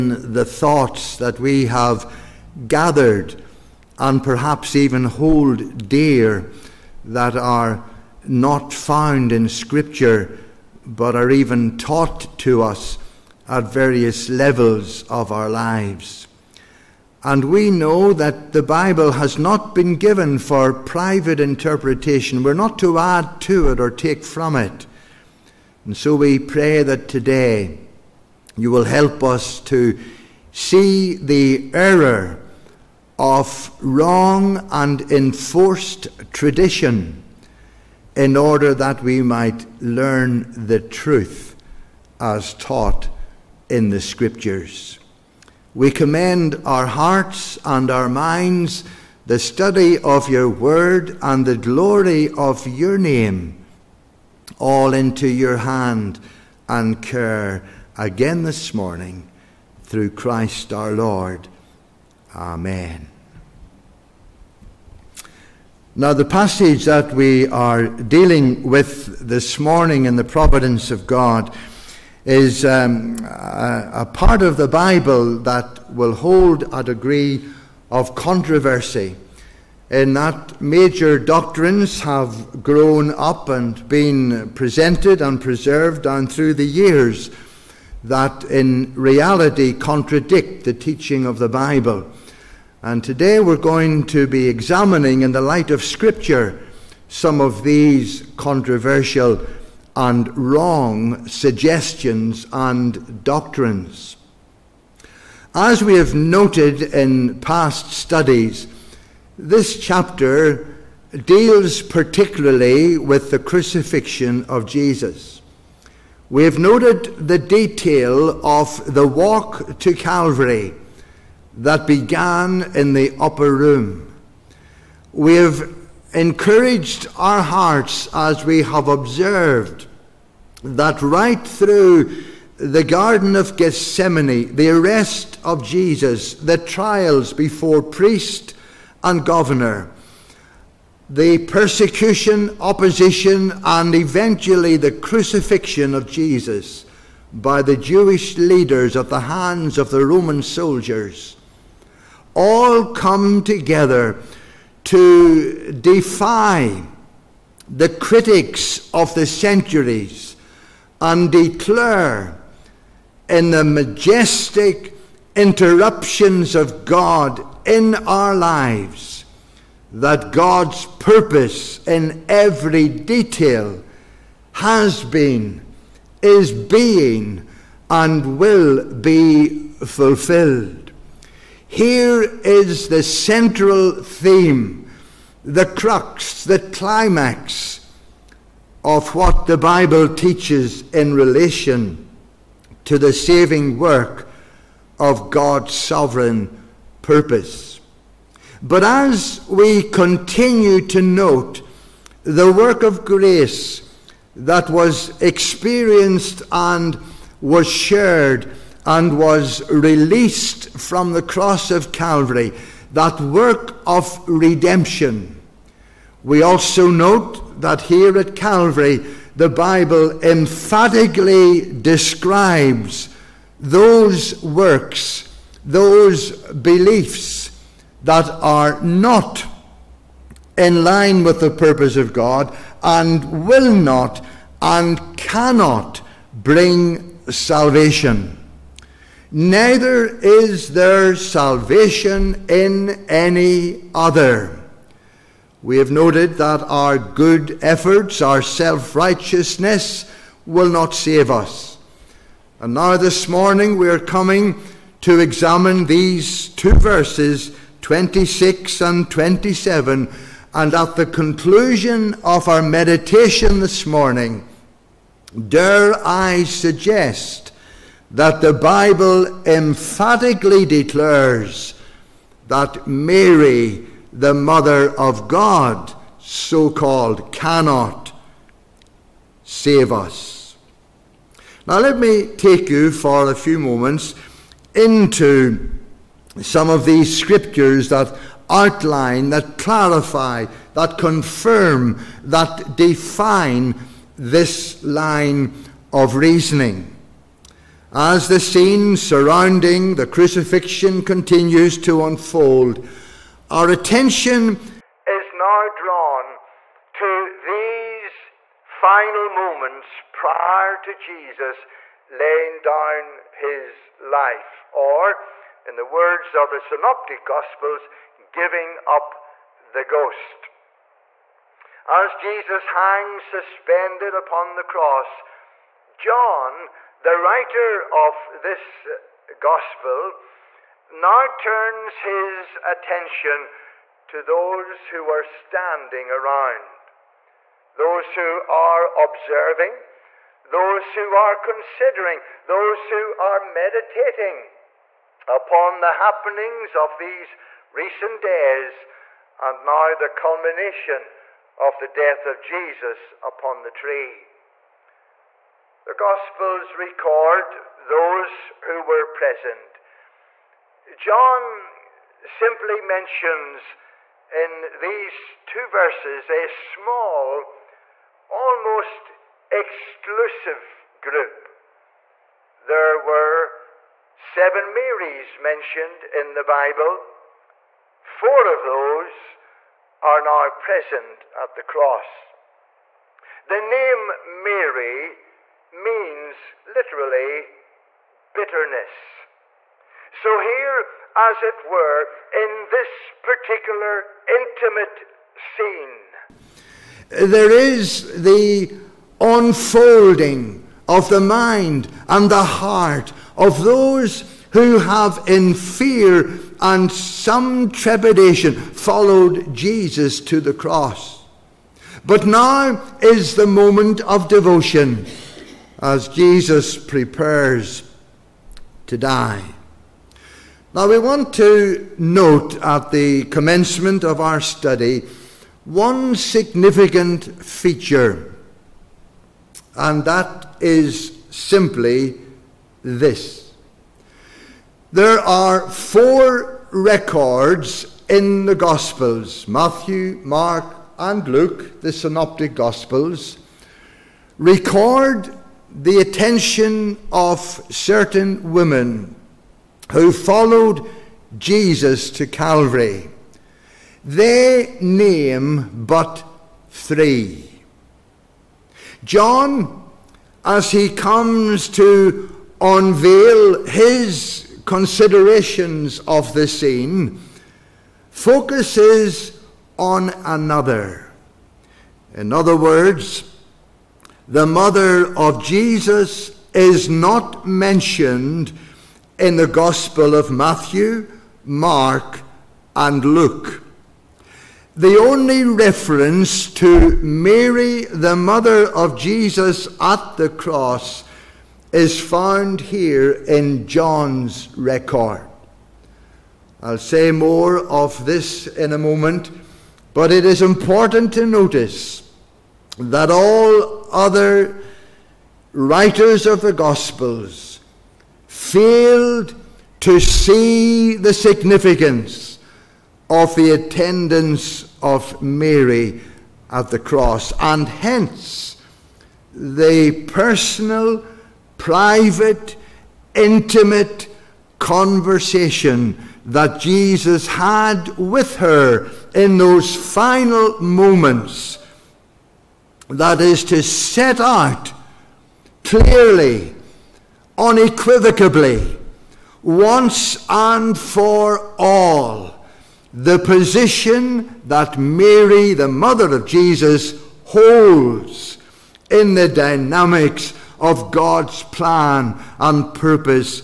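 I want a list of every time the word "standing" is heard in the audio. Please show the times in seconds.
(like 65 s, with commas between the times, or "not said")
335 s.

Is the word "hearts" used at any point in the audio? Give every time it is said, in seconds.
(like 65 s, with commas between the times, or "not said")
46 s, 127 s, 402 s.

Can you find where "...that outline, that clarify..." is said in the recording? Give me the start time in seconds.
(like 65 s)
287 s.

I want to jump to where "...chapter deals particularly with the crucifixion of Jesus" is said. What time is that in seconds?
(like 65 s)
109 s.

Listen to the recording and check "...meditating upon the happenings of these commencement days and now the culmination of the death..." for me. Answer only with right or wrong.
wrong.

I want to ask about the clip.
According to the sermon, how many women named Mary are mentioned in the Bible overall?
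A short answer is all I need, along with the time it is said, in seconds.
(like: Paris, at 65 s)
7, at 374 s.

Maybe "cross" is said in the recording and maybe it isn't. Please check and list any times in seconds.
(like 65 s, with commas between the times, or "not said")
211 s, 324 s, 381 s, 410 s, 490 s, 516 s.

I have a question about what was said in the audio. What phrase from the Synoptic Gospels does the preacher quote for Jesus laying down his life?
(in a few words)
Giving up the ghost.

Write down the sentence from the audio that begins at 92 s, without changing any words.
And today we're going to be examining, in the light of Scripture, some of these controversial and wrong suggestions and doctrines.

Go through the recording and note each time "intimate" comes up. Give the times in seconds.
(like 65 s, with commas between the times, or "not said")
394 s, 523 s.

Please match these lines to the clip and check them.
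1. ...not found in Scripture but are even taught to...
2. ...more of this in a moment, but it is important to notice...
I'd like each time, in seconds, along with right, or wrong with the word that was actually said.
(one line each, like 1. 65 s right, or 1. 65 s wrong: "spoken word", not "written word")
1. 8 s right
2. 497 s right.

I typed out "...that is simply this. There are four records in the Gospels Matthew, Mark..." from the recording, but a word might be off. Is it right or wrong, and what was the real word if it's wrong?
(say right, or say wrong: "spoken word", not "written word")
right.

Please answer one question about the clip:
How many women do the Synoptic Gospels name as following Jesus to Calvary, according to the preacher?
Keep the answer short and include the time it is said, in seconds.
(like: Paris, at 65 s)
3, at 456 s.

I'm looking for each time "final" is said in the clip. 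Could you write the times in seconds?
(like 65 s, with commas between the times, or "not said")
308 s, 529 s.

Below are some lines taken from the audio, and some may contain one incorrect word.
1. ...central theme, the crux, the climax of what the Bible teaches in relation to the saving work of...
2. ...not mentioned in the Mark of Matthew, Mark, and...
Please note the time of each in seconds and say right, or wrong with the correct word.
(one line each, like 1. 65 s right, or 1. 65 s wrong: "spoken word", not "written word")
1. 183 s right
2. 476 s wrong: "Gospel", not "Mark".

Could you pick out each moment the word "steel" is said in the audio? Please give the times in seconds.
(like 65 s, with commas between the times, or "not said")
not said.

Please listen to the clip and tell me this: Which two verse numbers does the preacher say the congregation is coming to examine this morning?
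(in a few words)
26 and 27.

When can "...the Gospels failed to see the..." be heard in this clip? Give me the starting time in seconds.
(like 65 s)
506 s.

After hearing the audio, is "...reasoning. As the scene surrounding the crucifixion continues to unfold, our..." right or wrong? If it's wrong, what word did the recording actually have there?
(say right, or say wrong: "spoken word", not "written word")
right.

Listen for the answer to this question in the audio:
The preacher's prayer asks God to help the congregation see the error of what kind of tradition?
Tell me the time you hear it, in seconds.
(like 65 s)
33 s.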